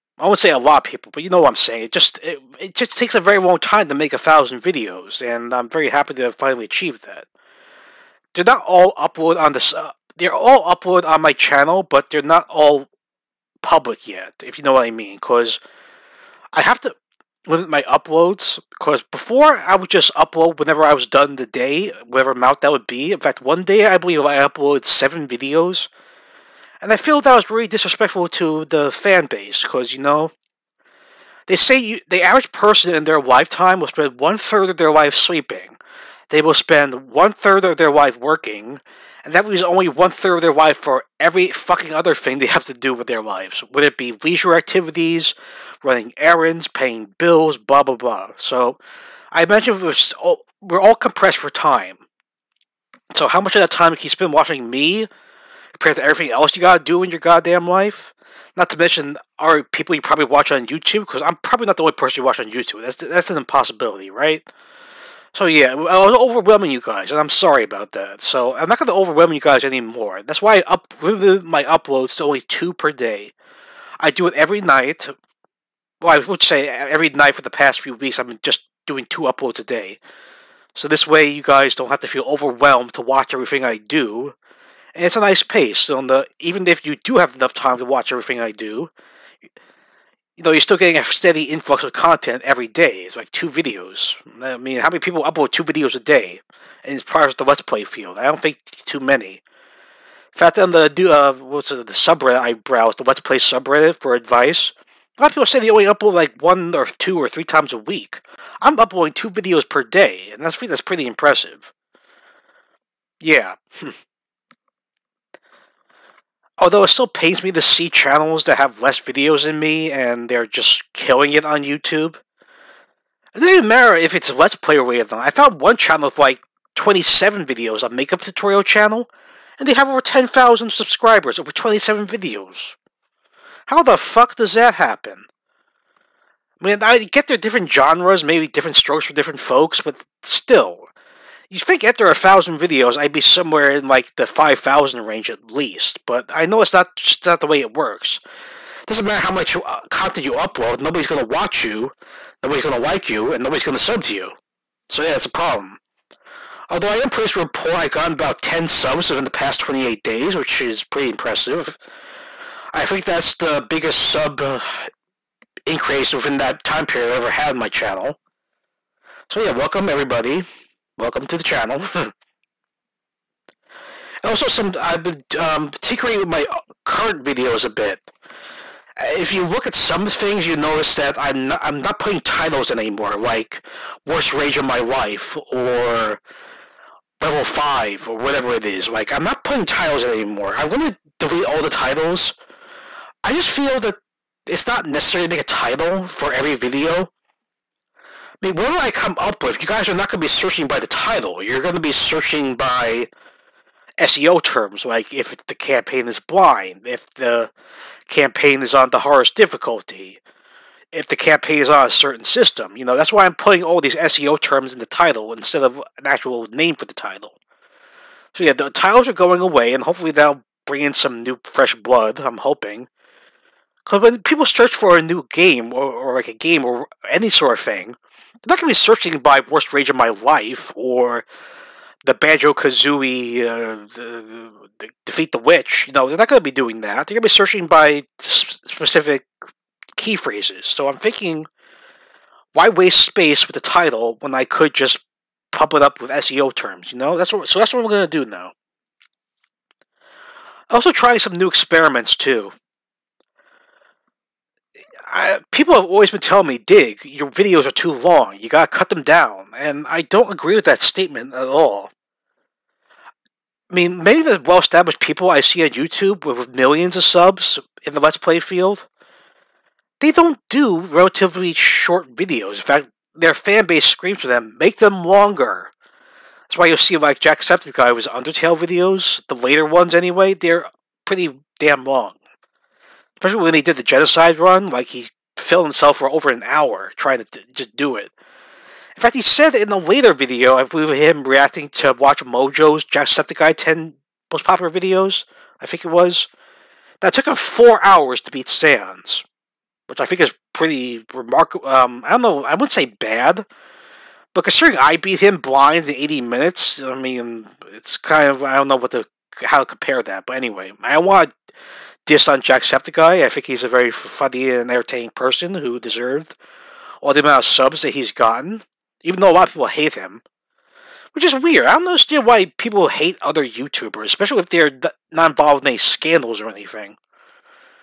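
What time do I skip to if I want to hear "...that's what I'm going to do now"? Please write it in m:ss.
4:07.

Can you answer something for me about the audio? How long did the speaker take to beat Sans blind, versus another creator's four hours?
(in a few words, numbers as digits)
80 minutes.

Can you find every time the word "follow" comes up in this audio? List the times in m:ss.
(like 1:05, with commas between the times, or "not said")
not said.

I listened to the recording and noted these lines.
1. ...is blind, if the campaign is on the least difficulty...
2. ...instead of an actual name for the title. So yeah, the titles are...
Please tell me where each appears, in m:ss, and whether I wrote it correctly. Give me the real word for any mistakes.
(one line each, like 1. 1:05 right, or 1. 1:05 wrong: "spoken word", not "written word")
1. 3:26 wrong: "hardest", not "least"
2. 3:35 right.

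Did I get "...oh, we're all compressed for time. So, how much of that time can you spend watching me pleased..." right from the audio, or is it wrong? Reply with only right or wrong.
wrong.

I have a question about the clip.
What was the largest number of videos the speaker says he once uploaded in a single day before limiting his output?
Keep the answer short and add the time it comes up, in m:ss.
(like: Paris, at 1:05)
7, at 0:24.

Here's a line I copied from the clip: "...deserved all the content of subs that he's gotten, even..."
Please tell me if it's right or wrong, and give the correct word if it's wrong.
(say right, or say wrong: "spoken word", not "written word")
wrong: "amount", not "content".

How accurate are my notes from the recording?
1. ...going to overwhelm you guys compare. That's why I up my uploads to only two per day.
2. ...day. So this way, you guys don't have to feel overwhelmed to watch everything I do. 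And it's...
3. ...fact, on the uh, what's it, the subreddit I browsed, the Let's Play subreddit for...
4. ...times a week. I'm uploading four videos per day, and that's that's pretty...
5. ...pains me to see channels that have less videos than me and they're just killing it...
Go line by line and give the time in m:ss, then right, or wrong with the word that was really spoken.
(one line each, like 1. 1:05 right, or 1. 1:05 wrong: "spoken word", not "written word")
1. 1:08 wrong: "anymore", not "compare"
2. 1:19 right
3. 1:40 right
4. 1:47 wrong: "two", not "four"
5. 1:57 right.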